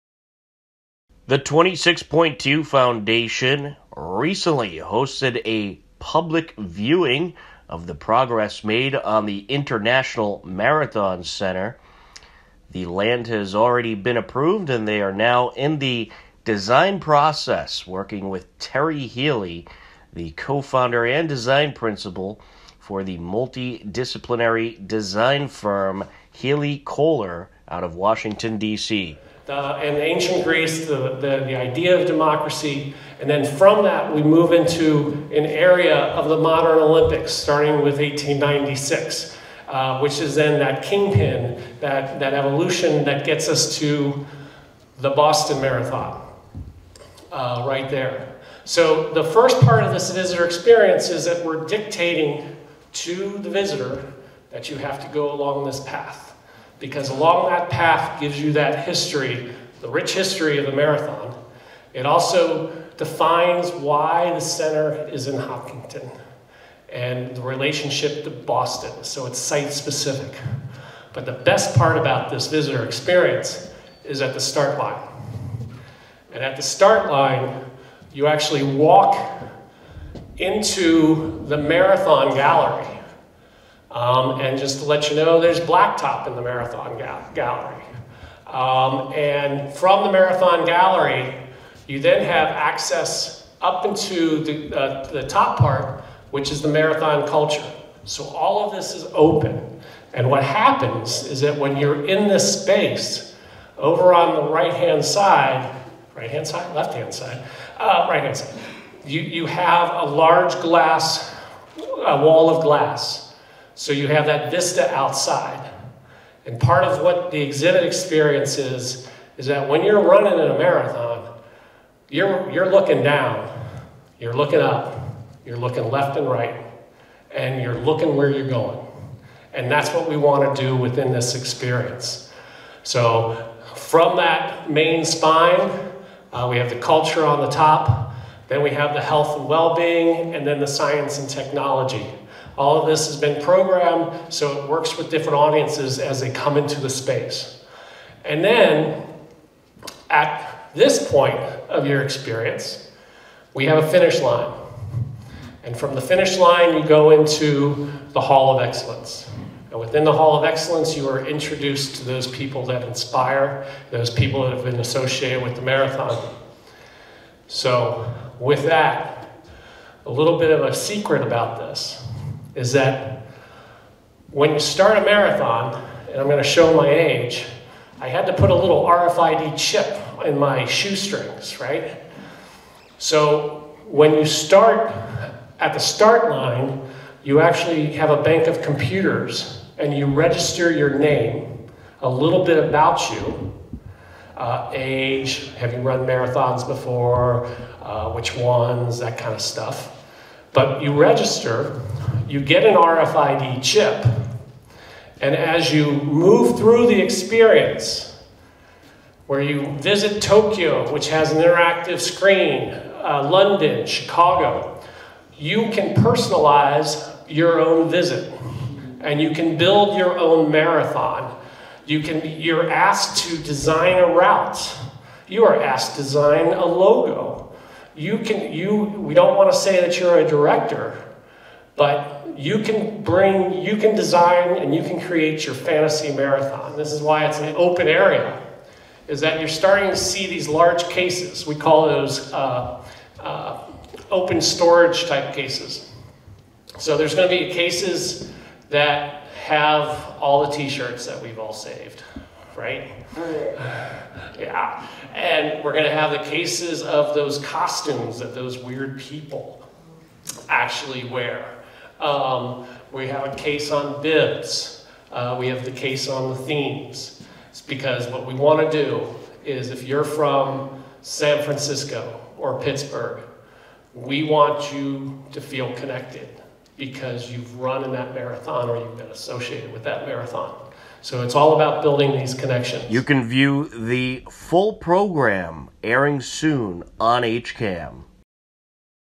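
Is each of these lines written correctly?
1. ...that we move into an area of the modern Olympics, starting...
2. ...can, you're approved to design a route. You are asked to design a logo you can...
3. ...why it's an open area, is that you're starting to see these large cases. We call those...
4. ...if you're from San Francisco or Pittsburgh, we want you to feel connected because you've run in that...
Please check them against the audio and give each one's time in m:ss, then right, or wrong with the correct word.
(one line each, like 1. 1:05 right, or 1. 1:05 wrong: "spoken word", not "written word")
1. 0:33 right
2. 3:42 wrong: "asked", not "approved"
3. 3:57 right
4. 4:29 right.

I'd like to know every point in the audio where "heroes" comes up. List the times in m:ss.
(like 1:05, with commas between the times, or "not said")
not said.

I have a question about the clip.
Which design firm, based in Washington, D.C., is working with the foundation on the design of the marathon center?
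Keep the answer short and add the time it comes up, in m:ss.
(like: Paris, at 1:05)
Healy Kohler, at 0:26.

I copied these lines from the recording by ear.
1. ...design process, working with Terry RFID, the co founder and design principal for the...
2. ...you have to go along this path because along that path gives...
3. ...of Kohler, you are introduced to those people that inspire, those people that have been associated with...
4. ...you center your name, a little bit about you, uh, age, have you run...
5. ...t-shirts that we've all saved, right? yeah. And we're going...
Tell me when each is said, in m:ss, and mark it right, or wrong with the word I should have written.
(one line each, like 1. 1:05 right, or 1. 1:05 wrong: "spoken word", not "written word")
1. 0:16 wrong: "Healy", not "RFID"
2. 0:54 right
3. 2:40 wrong: "Excellence", not "Kohler"
4. 3:09 wrong: "register", not "center"
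5. 4:10 right.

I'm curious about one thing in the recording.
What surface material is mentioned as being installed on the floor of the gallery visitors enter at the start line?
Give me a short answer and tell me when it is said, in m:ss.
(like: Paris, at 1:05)
blacktop, at 1:25.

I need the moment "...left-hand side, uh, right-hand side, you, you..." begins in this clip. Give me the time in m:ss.
1:46.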